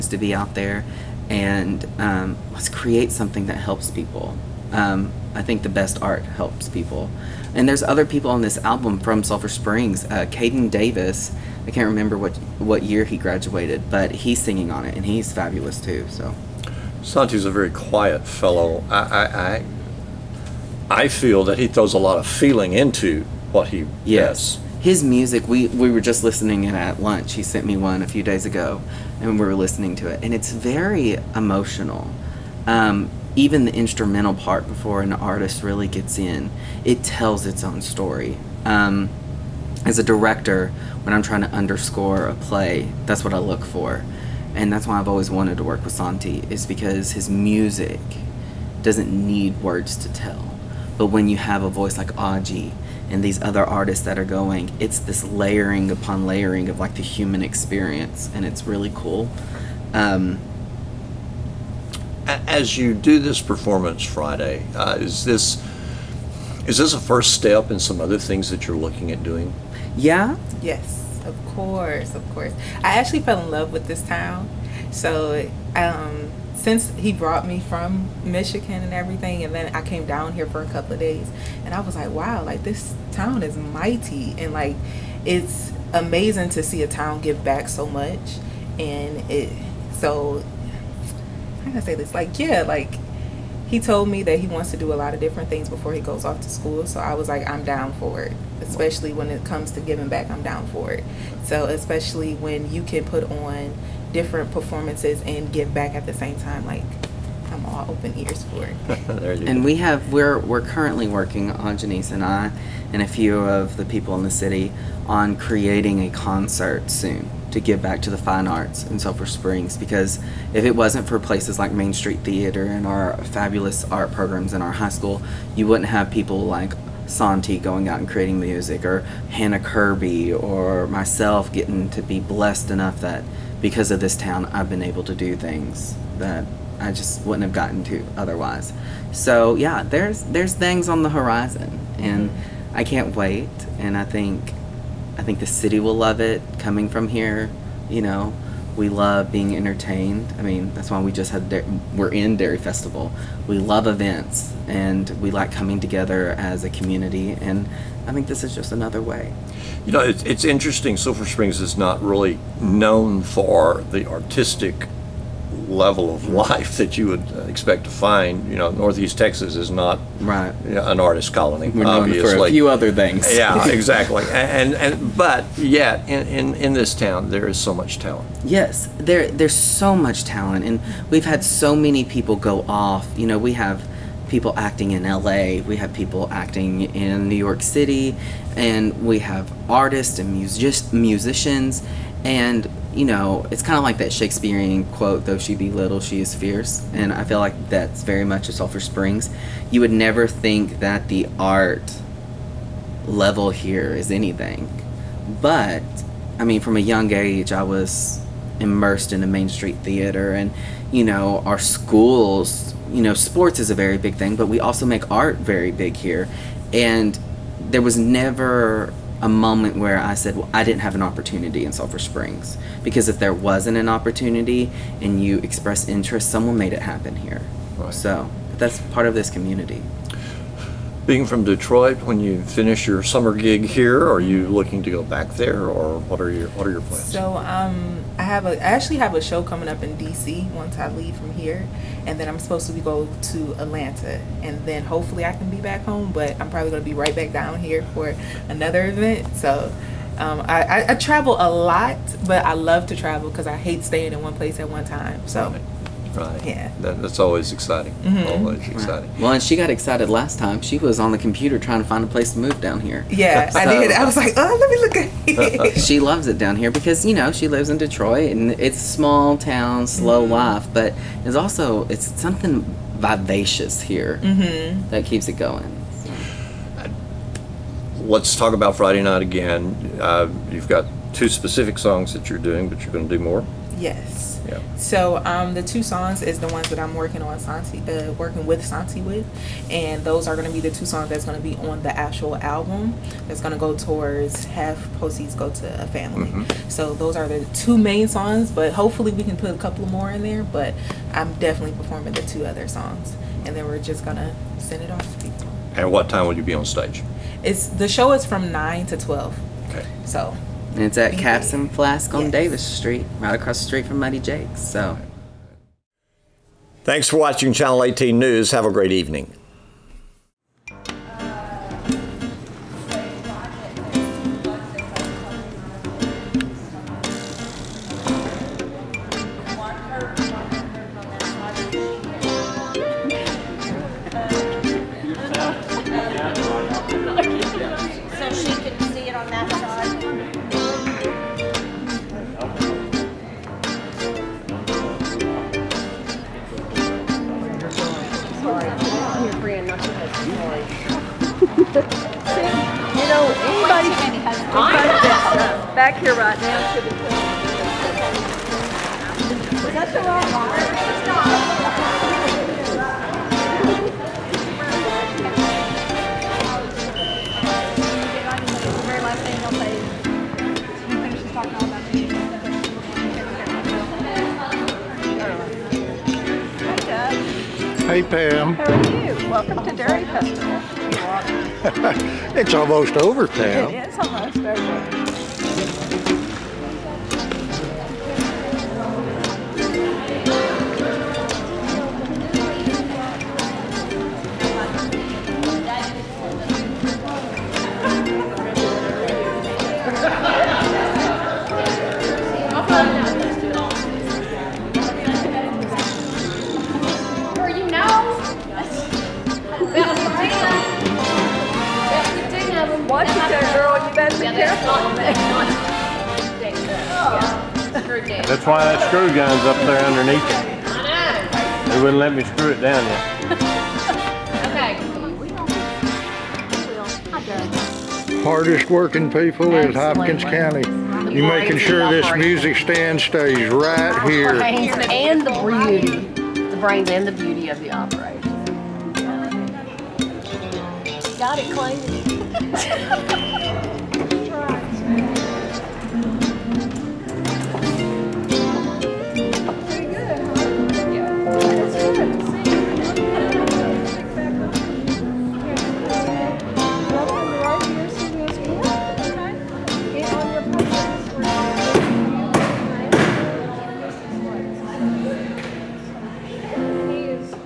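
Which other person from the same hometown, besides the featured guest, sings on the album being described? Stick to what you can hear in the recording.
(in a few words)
Caden Davis.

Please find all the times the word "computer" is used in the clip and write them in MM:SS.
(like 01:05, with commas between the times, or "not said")
04:21.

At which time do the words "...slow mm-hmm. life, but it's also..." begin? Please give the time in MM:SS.
04:29.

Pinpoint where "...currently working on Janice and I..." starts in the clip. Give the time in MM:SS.
01:50.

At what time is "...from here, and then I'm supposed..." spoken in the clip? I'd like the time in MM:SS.
04:01.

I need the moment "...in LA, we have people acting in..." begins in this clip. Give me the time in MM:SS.
03:04.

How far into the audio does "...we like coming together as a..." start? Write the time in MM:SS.
02:35.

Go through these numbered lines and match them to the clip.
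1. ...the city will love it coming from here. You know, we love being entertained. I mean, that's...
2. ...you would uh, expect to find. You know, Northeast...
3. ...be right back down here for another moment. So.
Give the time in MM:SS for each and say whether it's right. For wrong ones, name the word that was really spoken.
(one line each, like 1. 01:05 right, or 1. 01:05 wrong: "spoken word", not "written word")
1. 02:25 right
2. 02:46 right
3. 04:06 wrong: "event", not "moment".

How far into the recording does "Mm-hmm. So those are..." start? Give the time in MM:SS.
04:56.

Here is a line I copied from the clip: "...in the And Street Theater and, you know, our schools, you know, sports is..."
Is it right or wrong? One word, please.
wrong.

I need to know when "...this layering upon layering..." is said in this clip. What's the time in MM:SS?
00:54.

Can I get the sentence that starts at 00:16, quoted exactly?
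So, Santi's a very quiet fellow.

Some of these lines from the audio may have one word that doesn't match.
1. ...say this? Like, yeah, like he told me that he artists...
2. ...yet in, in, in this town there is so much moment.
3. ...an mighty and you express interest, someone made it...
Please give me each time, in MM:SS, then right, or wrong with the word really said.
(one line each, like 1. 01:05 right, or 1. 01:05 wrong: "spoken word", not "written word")
1. 01:31 wrong: "wants", not "artists"
2. 02:55 wrong: "talent", not "moment"
3. 03:43 wrong: "opportunity", not "mighty".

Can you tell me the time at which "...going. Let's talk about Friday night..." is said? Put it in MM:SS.
04:35.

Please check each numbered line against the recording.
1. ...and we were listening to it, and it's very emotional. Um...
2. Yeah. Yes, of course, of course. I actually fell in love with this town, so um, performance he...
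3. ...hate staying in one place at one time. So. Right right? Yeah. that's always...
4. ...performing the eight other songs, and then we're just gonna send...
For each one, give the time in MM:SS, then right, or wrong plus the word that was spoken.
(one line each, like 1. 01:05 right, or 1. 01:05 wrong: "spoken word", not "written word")
1. 00:29 right
2. 01:09 wrong: "since", not "performance"
3. 04:13 right
4. 05:01 wrong: "two", not "eight".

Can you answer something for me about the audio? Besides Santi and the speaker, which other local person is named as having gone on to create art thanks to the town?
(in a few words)
Hannah Kirby.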